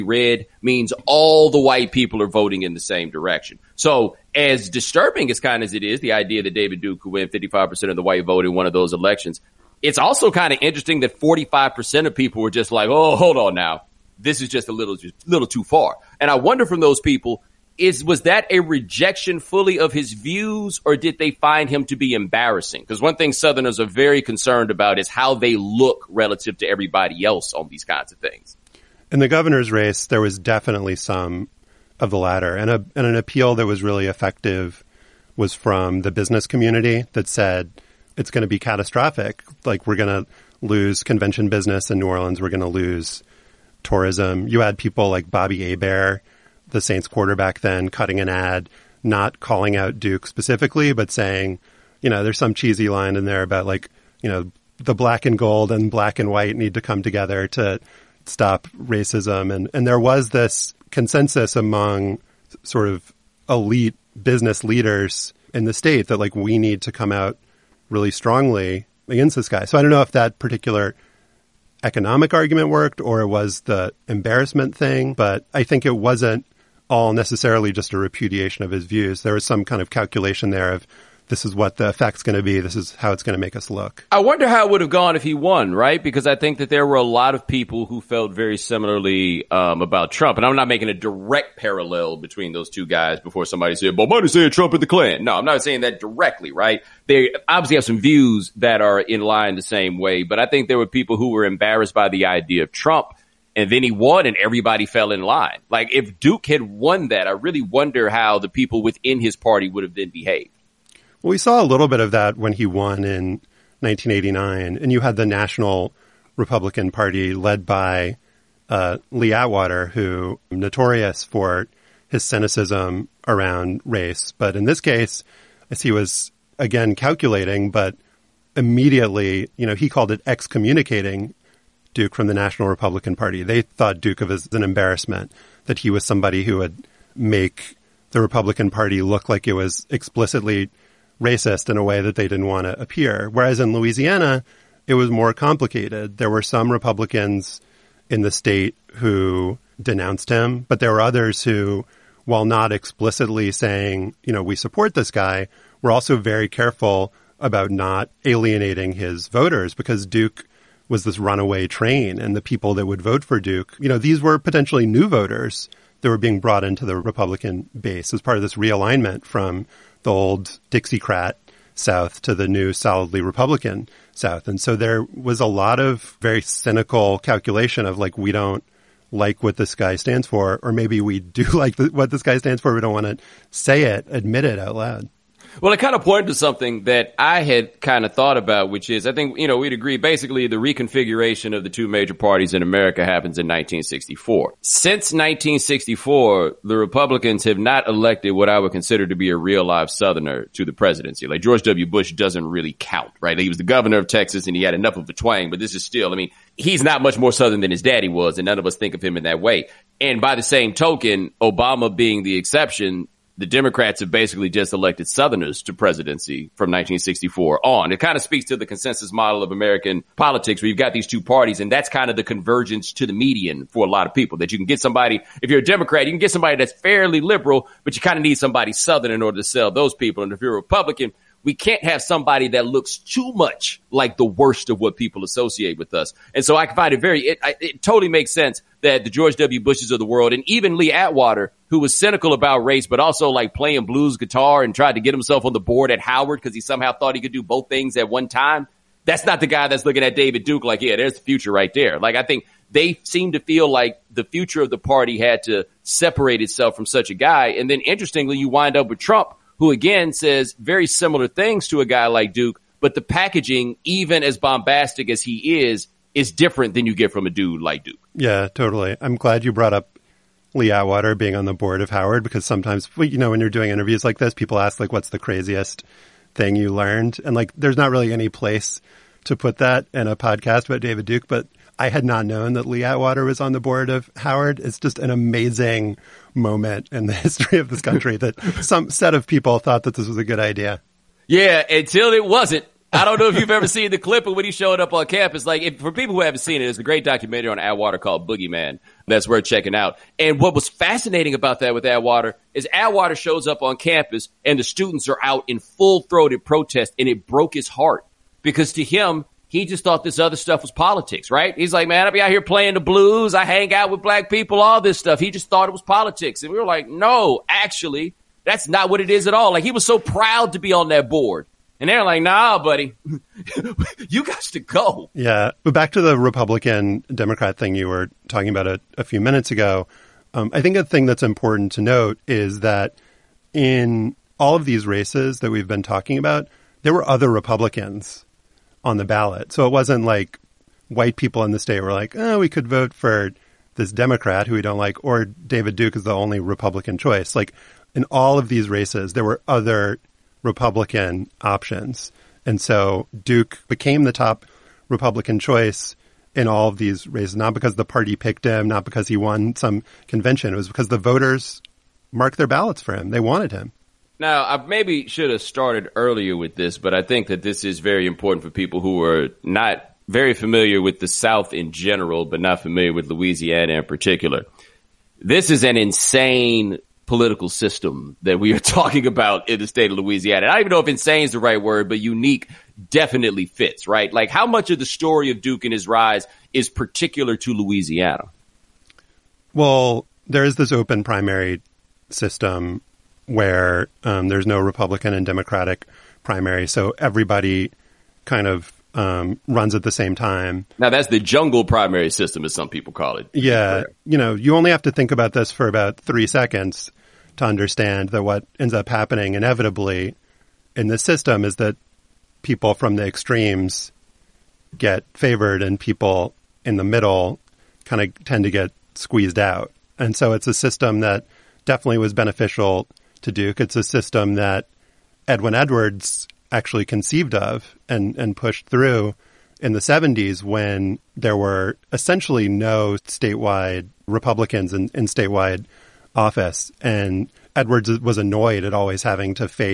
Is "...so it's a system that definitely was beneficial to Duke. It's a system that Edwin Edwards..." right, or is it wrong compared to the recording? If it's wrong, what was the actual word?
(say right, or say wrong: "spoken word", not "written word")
right.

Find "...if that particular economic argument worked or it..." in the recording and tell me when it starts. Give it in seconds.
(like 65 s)
70 s.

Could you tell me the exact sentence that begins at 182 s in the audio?
We don't want to say it, admit it out loud.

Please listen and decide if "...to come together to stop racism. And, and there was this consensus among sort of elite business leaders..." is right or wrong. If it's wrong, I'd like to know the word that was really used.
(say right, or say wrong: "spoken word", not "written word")
right.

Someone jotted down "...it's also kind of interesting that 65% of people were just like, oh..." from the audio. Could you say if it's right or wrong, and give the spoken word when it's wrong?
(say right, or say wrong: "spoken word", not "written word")
wrong: "45", not "65".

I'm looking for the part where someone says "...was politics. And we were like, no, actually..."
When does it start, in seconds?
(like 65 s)
315 s.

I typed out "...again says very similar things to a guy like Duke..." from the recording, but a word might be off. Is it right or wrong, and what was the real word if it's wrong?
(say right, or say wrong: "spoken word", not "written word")
right.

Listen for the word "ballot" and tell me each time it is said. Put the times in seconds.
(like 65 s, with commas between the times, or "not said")
339 s, 362 s.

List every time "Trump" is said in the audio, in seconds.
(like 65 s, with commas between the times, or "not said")
90 s, 94 s, 102 s, 258 s.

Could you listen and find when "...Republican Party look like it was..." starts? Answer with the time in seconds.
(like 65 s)
138 s.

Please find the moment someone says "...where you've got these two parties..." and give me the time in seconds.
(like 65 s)
220 s.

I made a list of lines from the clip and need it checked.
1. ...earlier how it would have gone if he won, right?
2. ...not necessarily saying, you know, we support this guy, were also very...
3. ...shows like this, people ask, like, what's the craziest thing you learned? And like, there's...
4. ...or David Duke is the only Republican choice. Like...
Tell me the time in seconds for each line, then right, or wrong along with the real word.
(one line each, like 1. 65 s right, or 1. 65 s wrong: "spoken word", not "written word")
1. 84 s wrong: "wonder", not "earlier"
2. 152 s wrong: "explicitly", not "necessarily"
3. 273 s wrong: "interviews", not "shows"
4. 345 s right.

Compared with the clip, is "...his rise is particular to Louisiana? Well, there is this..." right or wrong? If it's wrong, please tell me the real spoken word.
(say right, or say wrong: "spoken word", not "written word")
right.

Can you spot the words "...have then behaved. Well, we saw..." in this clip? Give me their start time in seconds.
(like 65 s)
109 s.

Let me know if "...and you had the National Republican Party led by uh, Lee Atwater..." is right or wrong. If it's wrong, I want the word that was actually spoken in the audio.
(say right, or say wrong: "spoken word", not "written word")
right.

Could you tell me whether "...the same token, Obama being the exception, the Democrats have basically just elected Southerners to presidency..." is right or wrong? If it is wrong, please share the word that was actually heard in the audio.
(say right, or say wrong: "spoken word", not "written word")
right.